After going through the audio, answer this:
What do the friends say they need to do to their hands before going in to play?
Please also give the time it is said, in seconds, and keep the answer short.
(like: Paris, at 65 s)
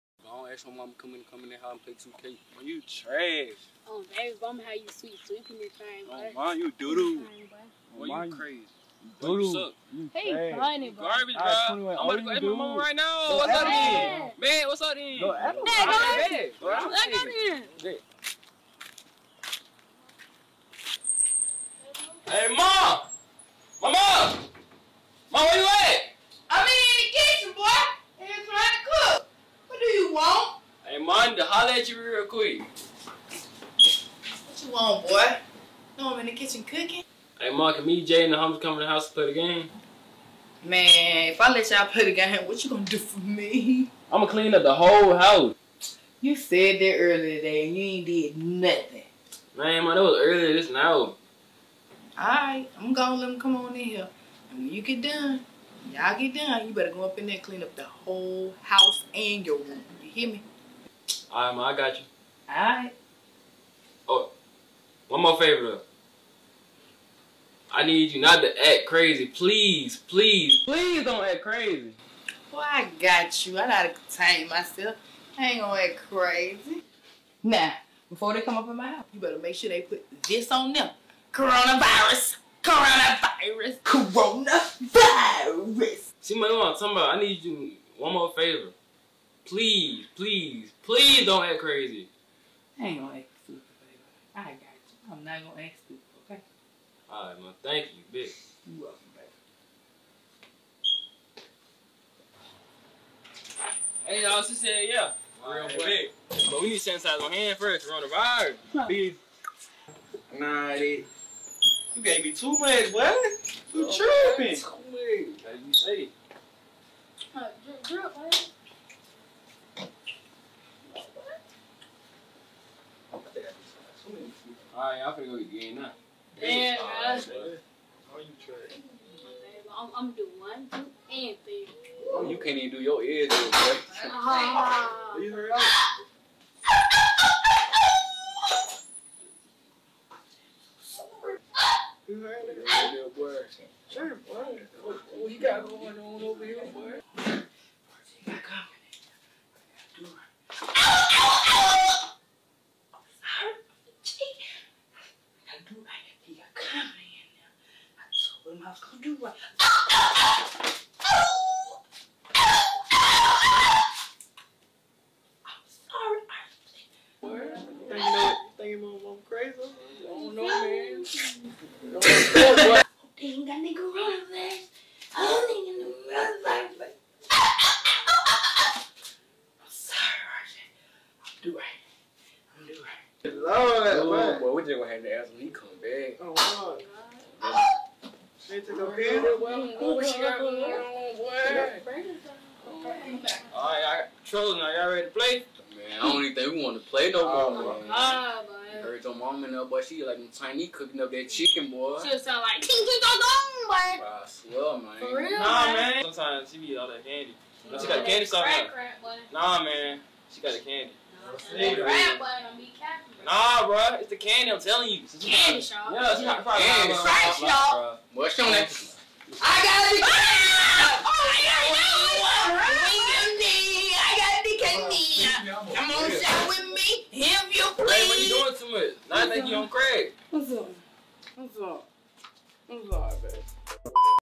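Sanitize, at 106 s.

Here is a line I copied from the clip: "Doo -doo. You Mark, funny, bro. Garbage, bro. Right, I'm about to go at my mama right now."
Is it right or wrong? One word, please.
wrong.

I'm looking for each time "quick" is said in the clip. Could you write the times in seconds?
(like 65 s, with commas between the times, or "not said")
32 s, 105 s.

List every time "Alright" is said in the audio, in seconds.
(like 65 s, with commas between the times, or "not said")
52 s, 97 s, 124 s.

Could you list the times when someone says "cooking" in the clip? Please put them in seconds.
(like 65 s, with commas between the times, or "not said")
36 s, 200 s.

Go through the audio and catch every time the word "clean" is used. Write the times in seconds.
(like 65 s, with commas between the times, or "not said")
44 s, 57 s.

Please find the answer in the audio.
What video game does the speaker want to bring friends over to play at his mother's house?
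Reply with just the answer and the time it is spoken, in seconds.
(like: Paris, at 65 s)
2K, at 2 s.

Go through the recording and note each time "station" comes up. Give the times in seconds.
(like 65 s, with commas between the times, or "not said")
not said.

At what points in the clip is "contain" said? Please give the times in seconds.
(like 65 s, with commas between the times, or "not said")
73 s.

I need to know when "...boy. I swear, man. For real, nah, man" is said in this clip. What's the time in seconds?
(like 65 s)
203 s.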